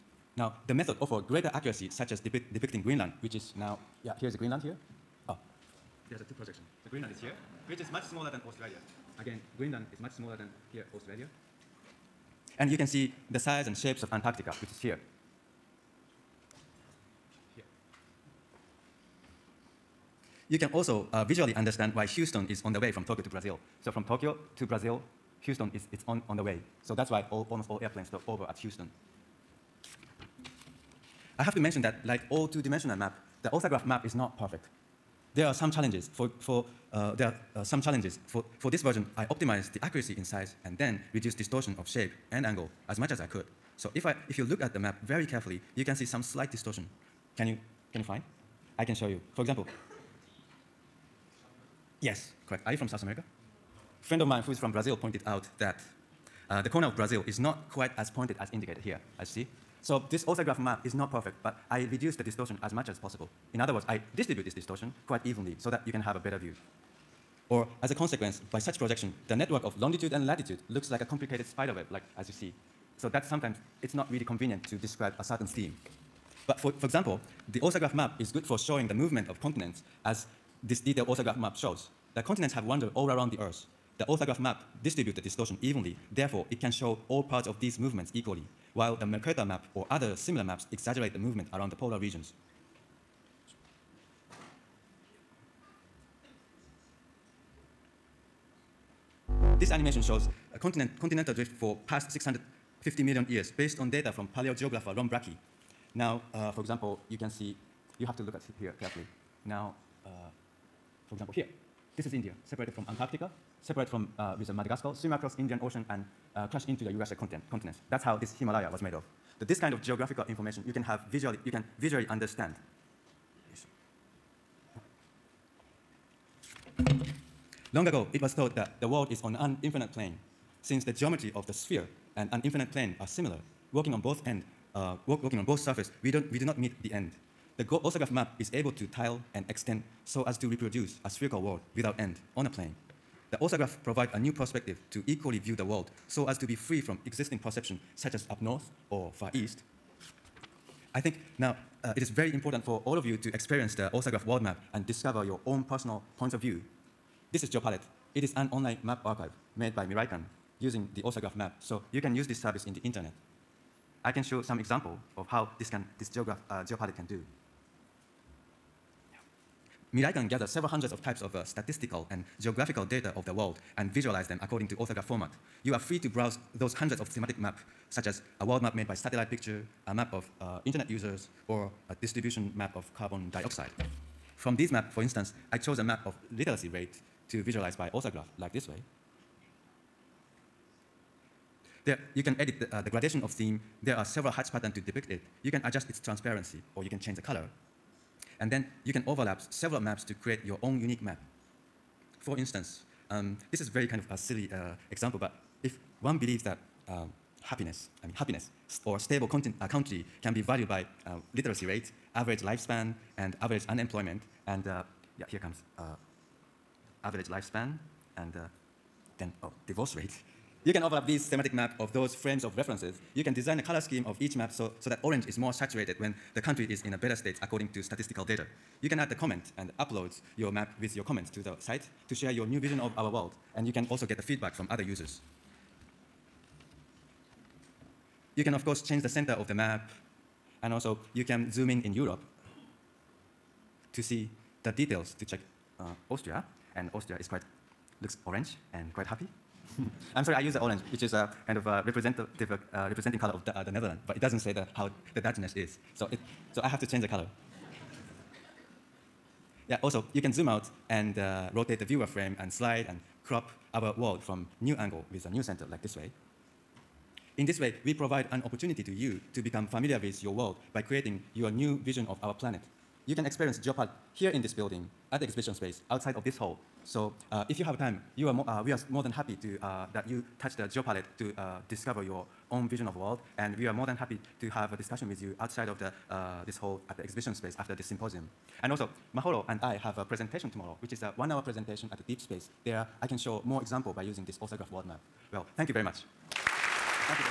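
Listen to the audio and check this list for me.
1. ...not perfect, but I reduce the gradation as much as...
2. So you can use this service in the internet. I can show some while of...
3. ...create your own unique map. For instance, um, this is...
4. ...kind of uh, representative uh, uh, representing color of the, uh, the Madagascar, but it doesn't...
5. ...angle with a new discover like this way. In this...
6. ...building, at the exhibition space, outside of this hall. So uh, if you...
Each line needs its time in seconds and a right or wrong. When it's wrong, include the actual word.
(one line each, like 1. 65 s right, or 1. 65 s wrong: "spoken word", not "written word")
1. 60 s wrong: "distortion", not "gradation"
2. 161 s wrong: "example", not "while"
3. 200 s right
4. 251 s wrong: "Netherlands", not "Madagascar"
5. 264 s wrong: "center", not "discover"
6. 274 s right.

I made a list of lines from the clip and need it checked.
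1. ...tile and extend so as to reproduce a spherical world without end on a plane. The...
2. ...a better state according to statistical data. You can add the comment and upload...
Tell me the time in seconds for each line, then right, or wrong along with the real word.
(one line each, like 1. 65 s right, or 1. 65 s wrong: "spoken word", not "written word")
1. 138 s right
2. 226 s right.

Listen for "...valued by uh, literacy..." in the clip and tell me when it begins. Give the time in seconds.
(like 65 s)
210 s.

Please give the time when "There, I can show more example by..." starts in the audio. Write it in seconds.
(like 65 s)
292 s.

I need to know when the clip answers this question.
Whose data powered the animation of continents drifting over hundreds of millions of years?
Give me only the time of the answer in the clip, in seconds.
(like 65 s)
104 s.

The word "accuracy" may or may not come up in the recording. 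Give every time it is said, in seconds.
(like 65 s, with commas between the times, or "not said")
1 s, 39 s.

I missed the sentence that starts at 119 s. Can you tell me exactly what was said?
That this kind of geographical information you can have visually, you can visually understand.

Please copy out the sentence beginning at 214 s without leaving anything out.
And uh, yeah, here comes uh, average lifespan, and uh, then oh, divorce rate.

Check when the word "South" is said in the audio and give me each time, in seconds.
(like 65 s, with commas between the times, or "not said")
52 s.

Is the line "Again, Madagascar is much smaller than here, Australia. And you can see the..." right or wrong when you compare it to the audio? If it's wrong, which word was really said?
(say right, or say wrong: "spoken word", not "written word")
wrong: "Greenland", not "Madagascar".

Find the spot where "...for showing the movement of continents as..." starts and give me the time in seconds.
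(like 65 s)
78 s.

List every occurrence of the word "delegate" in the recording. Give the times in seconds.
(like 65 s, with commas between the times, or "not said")
not said.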